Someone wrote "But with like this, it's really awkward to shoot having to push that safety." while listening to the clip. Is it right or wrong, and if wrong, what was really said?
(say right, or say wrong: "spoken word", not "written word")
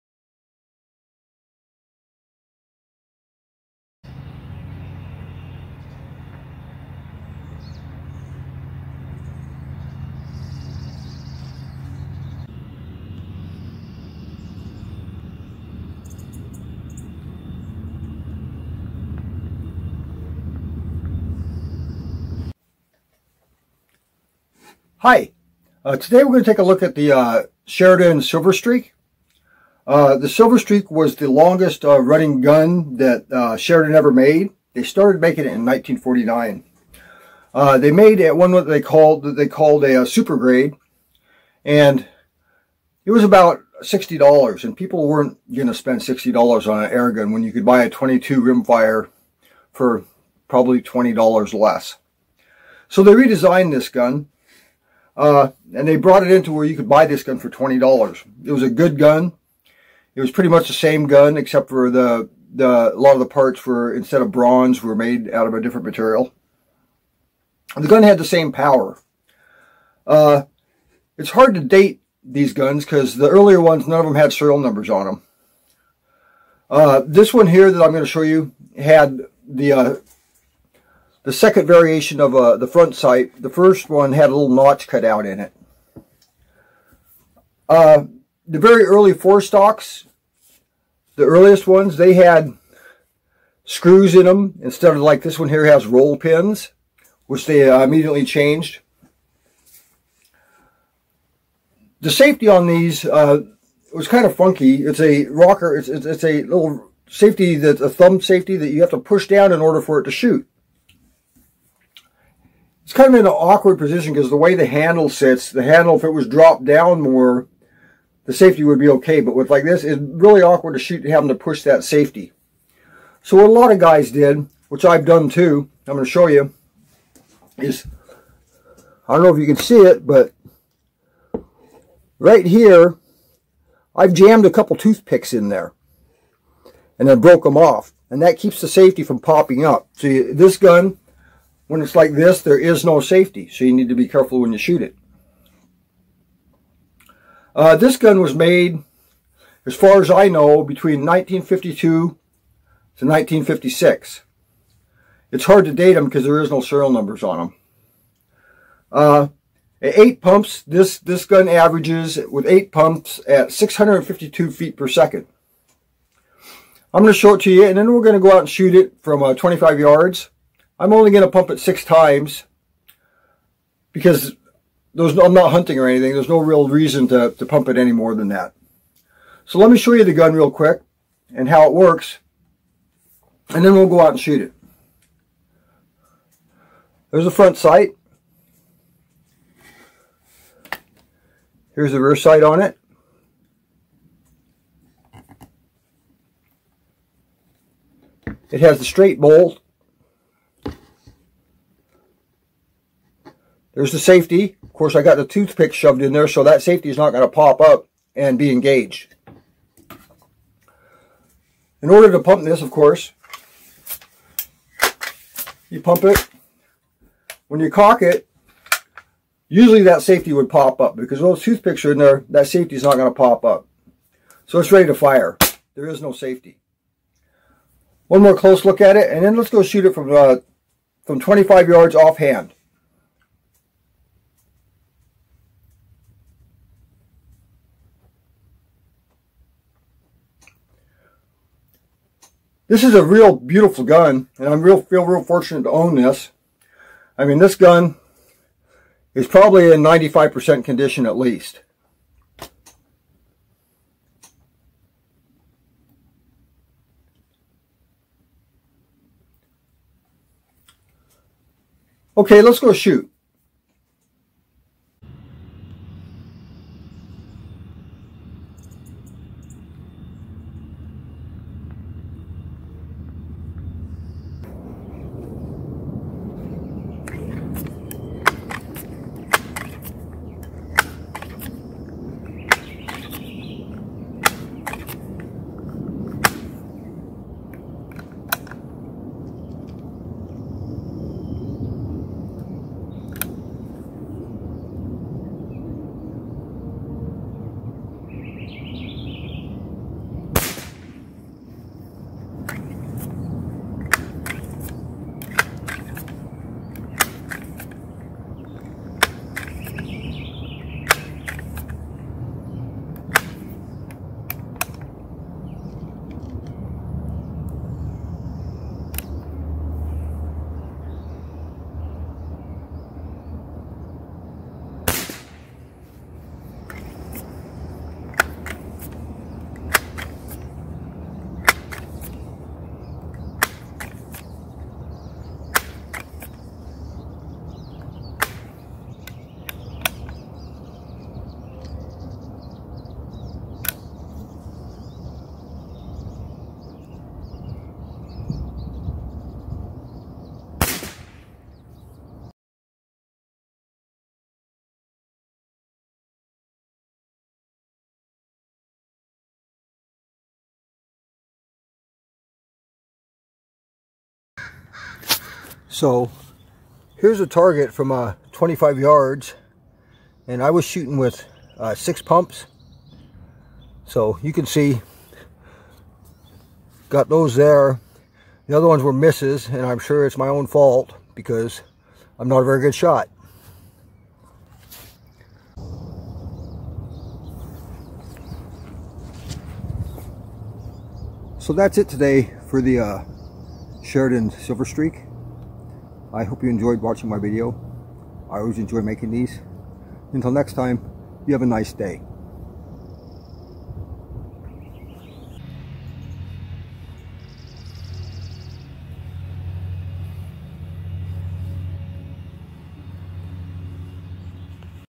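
right.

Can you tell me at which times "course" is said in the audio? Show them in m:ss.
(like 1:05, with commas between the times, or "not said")
3:24, 3:32.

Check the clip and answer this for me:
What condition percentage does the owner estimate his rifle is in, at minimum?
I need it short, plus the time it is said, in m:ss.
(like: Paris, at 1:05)
95%, at 4:09.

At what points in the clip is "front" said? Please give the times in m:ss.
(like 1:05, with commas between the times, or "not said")
1:22, 3:07.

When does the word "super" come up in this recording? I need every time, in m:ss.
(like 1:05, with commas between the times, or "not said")
0:40.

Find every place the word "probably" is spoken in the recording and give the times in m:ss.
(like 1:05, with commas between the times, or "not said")
0:50, 4:09.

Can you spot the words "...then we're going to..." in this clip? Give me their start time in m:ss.
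2:47.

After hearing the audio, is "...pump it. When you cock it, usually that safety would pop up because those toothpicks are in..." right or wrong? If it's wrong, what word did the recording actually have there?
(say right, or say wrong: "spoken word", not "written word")
right.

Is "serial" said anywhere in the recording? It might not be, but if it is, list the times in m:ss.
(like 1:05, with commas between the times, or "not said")
1:14, 2:36.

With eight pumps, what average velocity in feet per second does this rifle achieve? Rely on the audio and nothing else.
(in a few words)
652.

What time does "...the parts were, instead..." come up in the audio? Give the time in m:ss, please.
1:03.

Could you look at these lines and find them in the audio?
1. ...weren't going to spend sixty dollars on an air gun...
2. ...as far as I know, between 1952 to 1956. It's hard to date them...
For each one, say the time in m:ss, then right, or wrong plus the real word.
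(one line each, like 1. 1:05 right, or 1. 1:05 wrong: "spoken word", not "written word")
1. 0:45 right
2. 2:29 right.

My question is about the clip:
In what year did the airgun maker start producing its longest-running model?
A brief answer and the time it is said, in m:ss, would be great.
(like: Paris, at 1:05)
1949, at 0:35.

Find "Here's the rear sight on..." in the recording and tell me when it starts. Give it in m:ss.
3:11.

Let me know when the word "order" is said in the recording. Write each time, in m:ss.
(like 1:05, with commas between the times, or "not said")
1:49, 3:31.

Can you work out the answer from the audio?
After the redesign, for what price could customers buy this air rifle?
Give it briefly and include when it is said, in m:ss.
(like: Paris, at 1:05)
$20, at 0:57.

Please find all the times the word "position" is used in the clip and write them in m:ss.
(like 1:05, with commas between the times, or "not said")
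1:53.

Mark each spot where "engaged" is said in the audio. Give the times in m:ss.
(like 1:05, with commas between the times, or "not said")
3:28.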